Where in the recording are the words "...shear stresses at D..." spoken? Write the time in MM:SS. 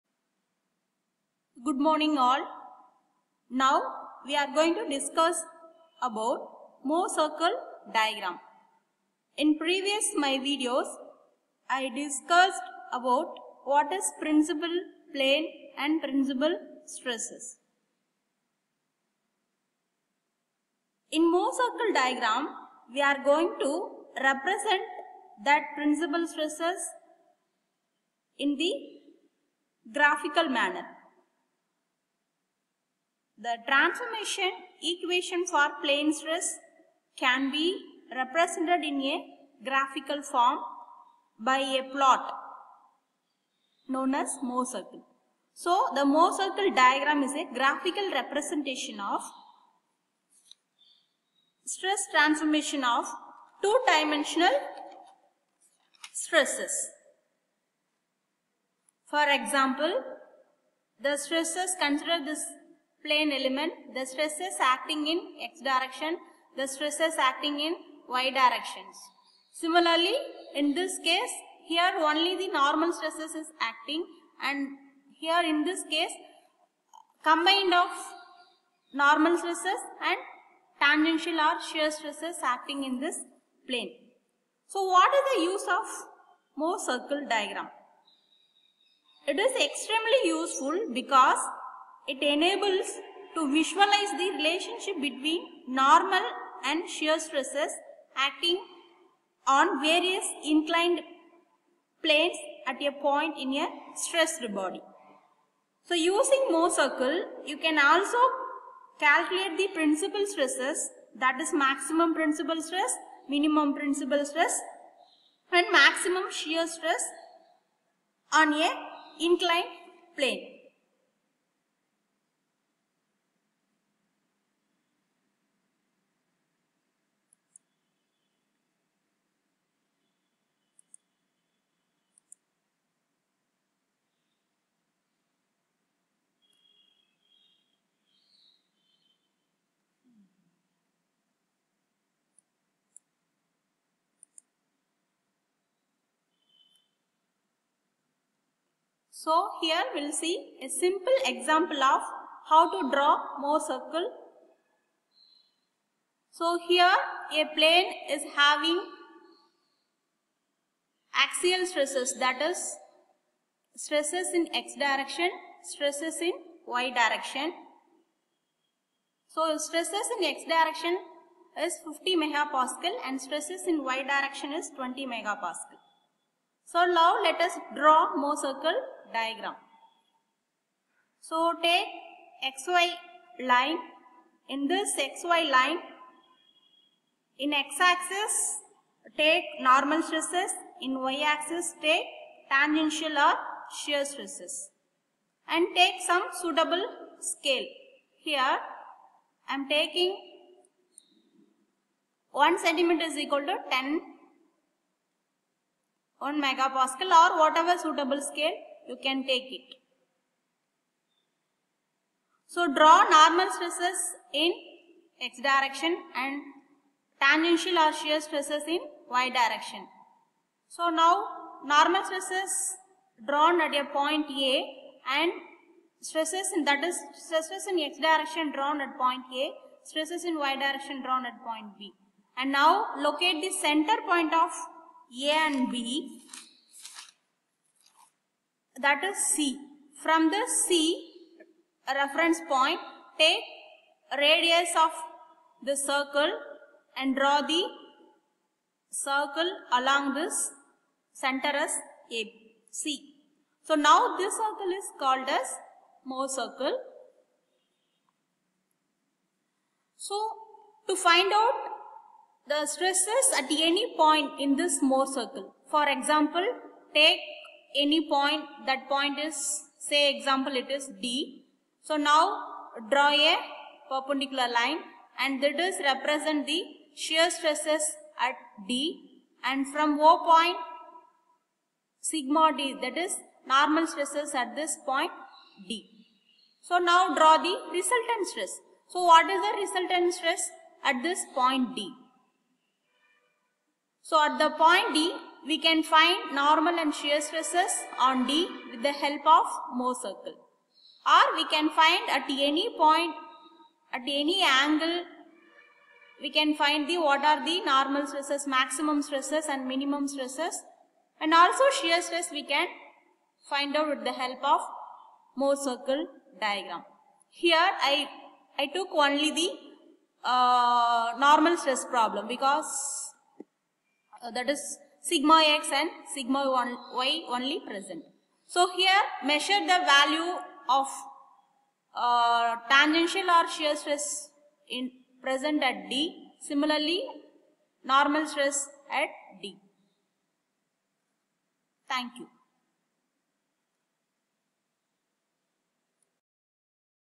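04:36.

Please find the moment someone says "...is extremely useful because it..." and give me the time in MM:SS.
01:29.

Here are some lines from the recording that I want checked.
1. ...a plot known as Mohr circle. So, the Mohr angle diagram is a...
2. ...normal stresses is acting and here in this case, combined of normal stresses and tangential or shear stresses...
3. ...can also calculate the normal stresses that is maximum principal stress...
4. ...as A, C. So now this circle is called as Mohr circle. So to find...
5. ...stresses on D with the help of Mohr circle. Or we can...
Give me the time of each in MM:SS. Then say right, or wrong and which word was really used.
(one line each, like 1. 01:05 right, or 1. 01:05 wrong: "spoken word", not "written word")
1. 00:41 wrong: "circle", not "angle"
2. 01:12 right
3. 01:47 wrong: "principal", not "normal"
4. 04:11 right
5. 04:57 right.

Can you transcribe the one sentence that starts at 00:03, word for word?
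Now we are going to discuss about Mohr circle diagram.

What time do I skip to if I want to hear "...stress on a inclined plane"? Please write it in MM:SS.
01:56.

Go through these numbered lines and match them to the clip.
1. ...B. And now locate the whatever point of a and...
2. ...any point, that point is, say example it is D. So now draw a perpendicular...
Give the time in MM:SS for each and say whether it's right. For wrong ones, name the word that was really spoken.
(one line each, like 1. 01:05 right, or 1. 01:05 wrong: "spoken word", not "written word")
1. 03:51 wrong: "center", not "whatever"
2. 04:27 right.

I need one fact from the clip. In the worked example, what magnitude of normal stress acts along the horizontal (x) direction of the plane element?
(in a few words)
50 megapascal.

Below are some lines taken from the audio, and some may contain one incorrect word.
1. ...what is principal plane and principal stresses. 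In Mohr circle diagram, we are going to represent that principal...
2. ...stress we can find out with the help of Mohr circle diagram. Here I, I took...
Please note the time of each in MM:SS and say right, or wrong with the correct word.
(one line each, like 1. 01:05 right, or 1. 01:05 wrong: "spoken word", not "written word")
1. 00:13 right
2. 05:12 right.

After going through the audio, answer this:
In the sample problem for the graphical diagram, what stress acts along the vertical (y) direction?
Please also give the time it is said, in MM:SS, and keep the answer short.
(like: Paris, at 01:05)
20 megapascal, at 02:54.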